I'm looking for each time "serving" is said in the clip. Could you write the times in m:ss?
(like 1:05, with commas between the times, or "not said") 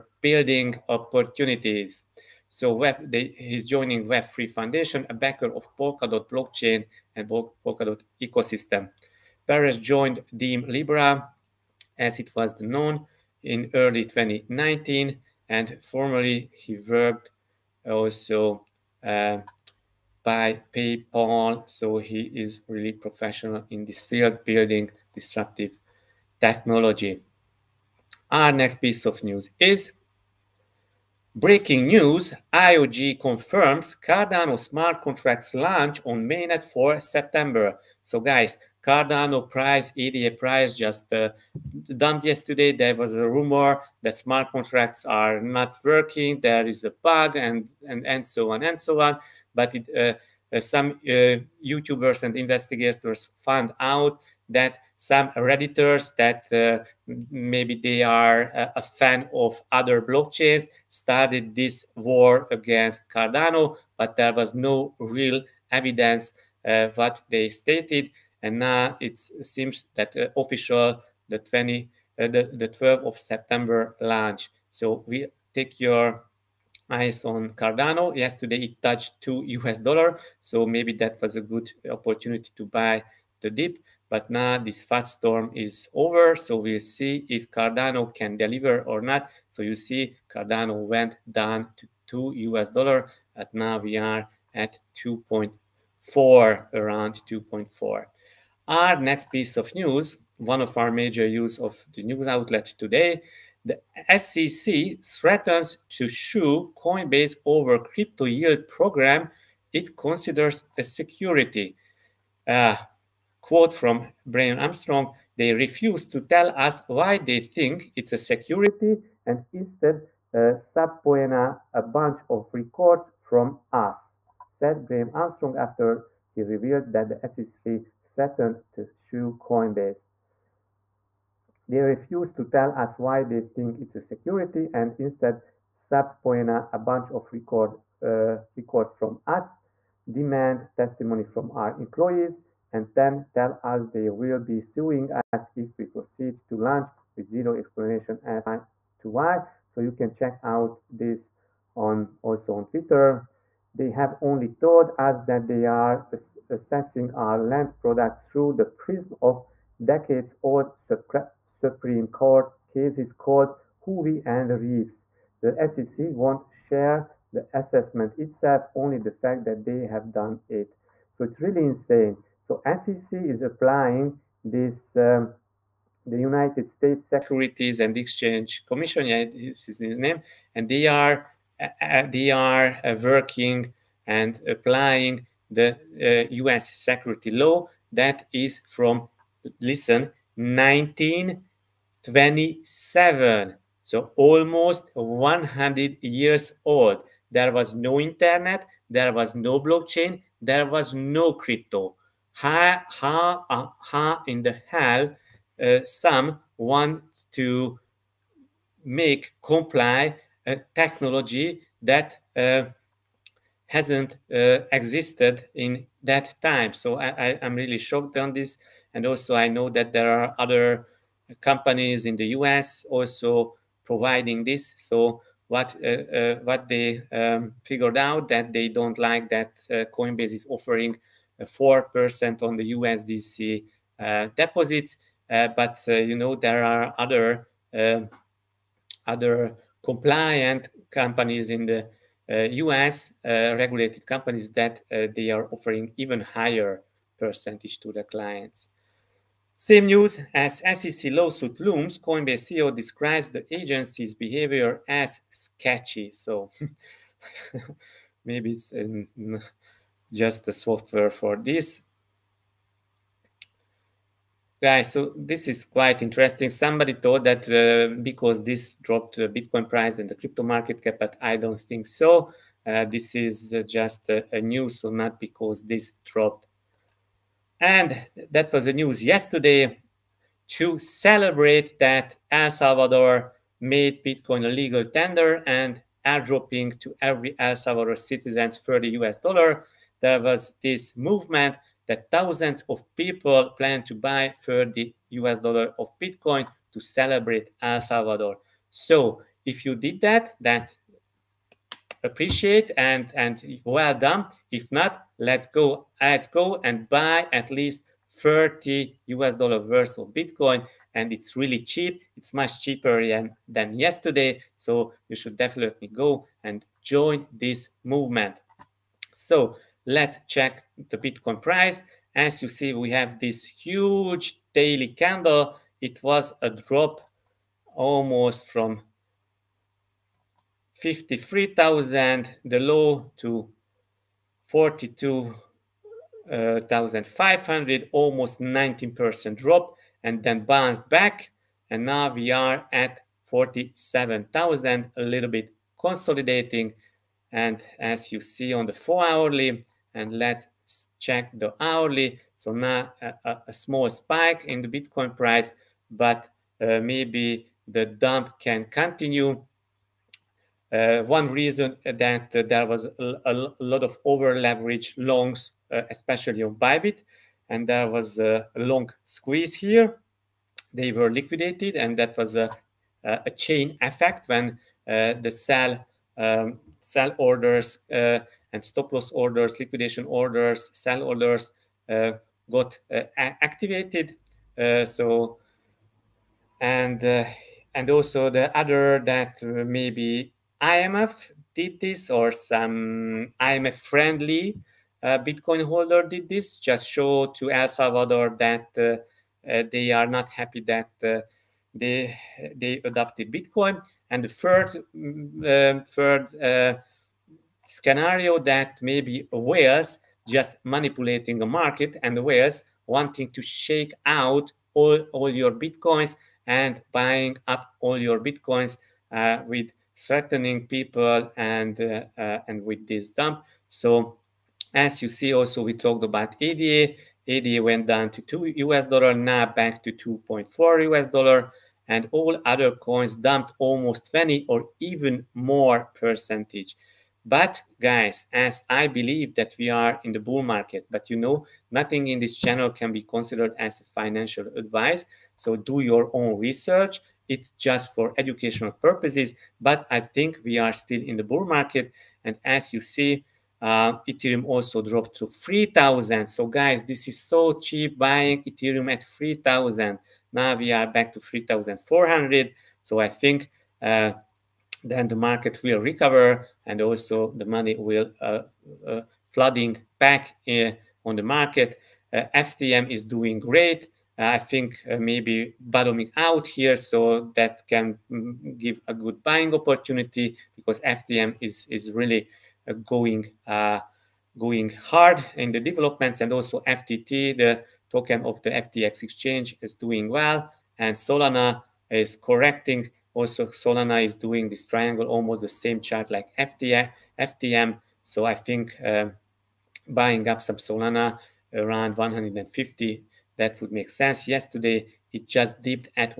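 not said.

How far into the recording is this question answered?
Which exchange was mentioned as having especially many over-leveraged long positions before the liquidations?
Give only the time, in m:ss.
6:06.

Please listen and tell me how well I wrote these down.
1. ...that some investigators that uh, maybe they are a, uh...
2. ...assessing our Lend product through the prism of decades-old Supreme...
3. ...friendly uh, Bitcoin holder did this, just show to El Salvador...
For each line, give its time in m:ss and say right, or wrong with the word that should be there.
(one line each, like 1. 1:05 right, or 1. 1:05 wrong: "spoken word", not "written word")
1. 0:54 wrong: "redditors", not "investigators"
2. 2:36 right
3. 6:33 right.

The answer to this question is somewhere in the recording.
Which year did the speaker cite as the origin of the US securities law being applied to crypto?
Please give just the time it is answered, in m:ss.
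3:10.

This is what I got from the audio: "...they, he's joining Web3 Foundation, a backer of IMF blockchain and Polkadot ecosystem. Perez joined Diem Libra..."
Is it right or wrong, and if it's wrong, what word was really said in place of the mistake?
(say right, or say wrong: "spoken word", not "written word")
wrong: "Polkadot", not "IMF".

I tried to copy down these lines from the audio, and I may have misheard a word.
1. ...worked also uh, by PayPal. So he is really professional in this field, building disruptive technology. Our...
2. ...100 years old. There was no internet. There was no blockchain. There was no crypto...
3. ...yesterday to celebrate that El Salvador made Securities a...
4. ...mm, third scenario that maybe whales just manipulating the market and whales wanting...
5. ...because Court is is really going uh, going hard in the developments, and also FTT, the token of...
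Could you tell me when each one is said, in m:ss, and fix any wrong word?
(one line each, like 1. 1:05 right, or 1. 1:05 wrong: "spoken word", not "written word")
1. 0:16 right
2. 3:14 right
3. 4:39 wrong: "Bitcoin", not "Securities"
4. 6:44 right
5. 8:00 wrong: "FTM", not "Court".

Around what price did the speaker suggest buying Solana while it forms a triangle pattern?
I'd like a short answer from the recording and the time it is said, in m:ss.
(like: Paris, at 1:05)
150, at 8:21.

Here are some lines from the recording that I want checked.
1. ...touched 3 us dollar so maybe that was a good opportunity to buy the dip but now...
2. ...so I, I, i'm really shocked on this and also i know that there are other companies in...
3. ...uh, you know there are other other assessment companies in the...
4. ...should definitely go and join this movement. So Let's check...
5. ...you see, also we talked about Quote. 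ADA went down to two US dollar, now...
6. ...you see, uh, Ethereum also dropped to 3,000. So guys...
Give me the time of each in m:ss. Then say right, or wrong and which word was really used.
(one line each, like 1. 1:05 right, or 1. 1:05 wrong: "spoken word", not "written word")
1. 1:18 wrong: "2", not "3"
2. 3:36 right
3. 3:55 wrong: "compliant", not "assessment"
4. 5:15 right
5. 7:05 wrong: "ADA", not "Quote"
6. 7:32 right.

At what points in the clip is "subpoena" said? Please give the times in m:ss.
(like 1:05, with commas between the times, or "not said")
2:00, 2:15.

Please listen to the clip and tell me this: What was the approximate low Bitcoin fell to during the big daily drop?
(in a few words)
42,500.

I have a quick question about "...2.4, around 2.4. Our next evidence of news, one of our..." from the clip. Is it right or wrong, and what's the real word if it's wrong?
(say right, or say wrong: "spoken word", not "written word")
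wrong: "piece", not "evidence".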